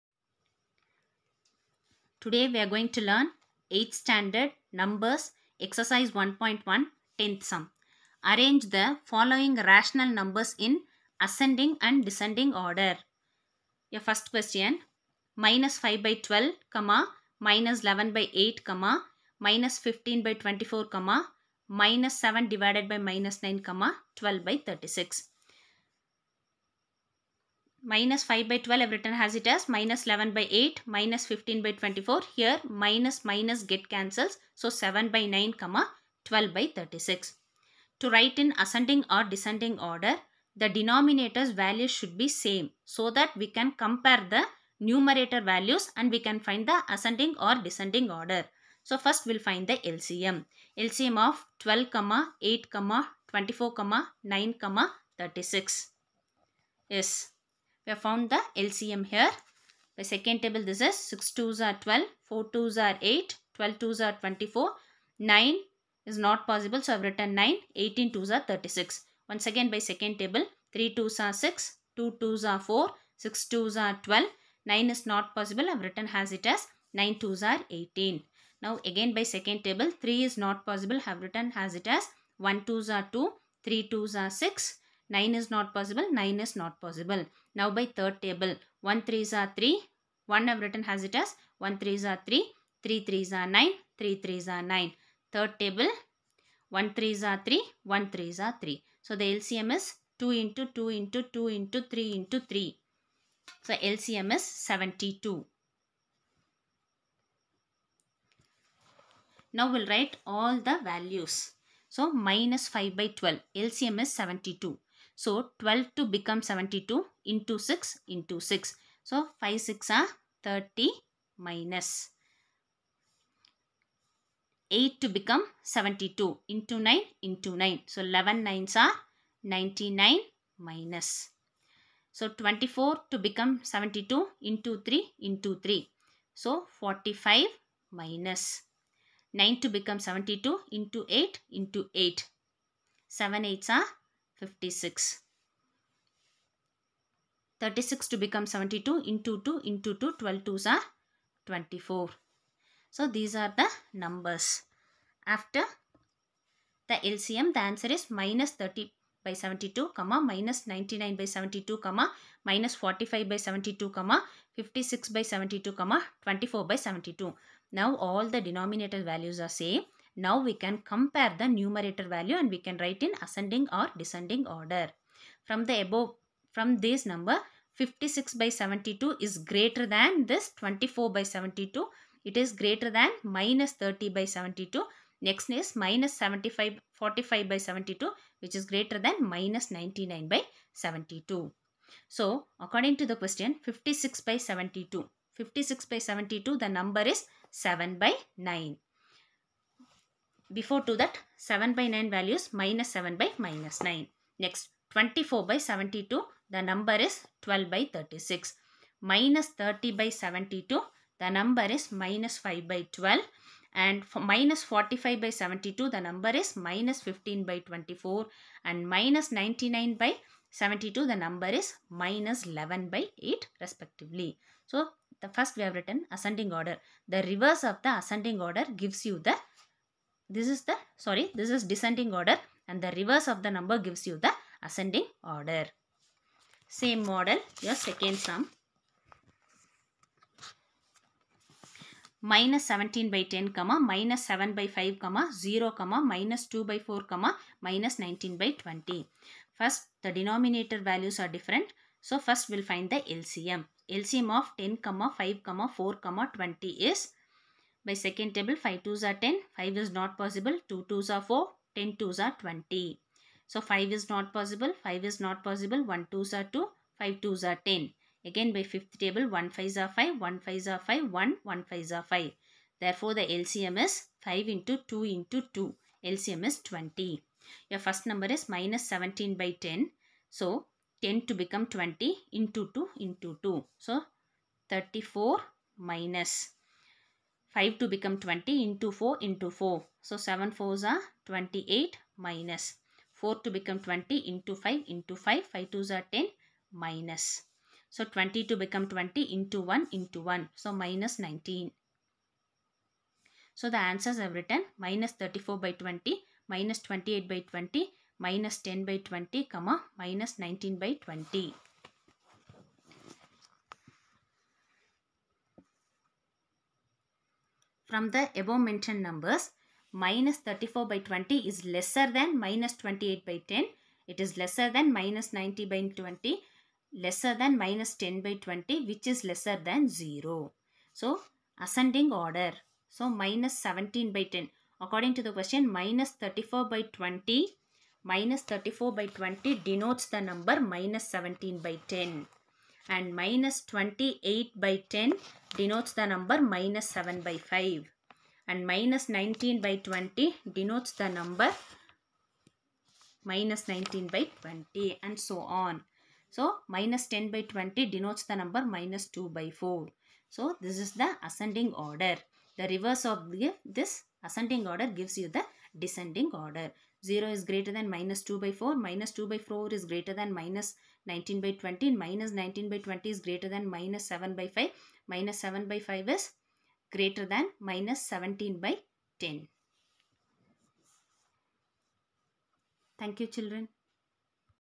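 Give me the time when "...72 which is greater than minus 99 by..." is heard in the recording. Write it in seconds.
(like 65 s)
187 s.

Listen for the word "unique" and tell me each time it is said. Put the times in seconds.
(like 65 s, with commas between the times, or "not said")
not said.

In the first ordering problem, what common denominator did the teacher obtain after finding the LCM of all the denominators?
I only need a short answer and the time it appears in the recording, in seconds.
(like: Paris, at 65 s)
72, at 103 s.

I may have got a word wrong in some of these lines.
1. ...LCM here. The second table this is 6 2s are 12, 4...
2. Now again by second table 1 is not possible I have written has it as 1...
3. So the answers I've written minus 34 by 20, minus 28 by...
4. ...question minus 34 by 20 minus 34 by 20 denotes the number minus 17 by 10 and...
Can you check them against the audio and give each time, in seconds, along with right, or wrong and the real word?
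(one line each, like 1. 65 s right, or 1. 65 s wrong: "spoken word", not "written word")
1. 58 s right
2. 78 s wrong: "3", not "1"
3. 303 s right
4. 335 s right.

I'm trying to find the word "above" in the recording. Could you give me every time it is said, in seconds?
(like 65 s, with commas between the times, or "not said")
175 s, 318 s.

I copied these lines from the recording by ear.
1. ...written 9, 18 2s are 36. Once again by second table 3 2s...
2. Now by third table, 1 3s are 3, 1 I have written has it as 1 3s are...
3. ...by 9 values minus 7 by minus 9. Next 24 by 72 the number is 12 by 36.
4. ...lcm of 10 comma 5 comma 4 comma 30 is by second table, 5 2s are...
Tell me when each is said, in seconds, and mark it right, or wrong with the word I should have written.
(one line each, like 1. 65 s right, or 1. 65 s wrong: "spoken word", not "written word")
1. 67 s right
2. 87 s right
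3. 201 s right
4. 254 s wrong: "20", not "30".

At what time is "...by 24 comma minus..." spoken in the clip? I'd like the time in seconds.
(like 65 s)
20 s.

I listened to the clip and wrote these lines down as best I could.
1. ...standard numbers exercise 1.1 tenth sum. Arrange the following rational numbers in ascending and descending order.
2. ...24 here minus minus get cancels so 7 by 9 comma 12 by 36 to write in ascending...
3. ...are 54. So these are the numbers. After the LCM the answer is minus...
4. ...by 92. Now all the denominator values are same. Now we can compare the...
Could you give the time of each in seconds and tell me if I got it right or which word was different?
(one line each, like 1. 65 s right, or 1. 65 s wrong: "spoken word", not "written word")
1. 3 s right
2. 31 s right
3. 150 s wrong: "24", not "54"
4. 166 s wrong: "72", not "92".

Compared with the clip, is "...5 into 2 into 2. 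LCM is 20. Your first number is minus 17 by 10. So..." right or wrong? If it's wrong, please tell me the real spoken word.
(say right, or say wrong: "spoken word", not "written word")
right.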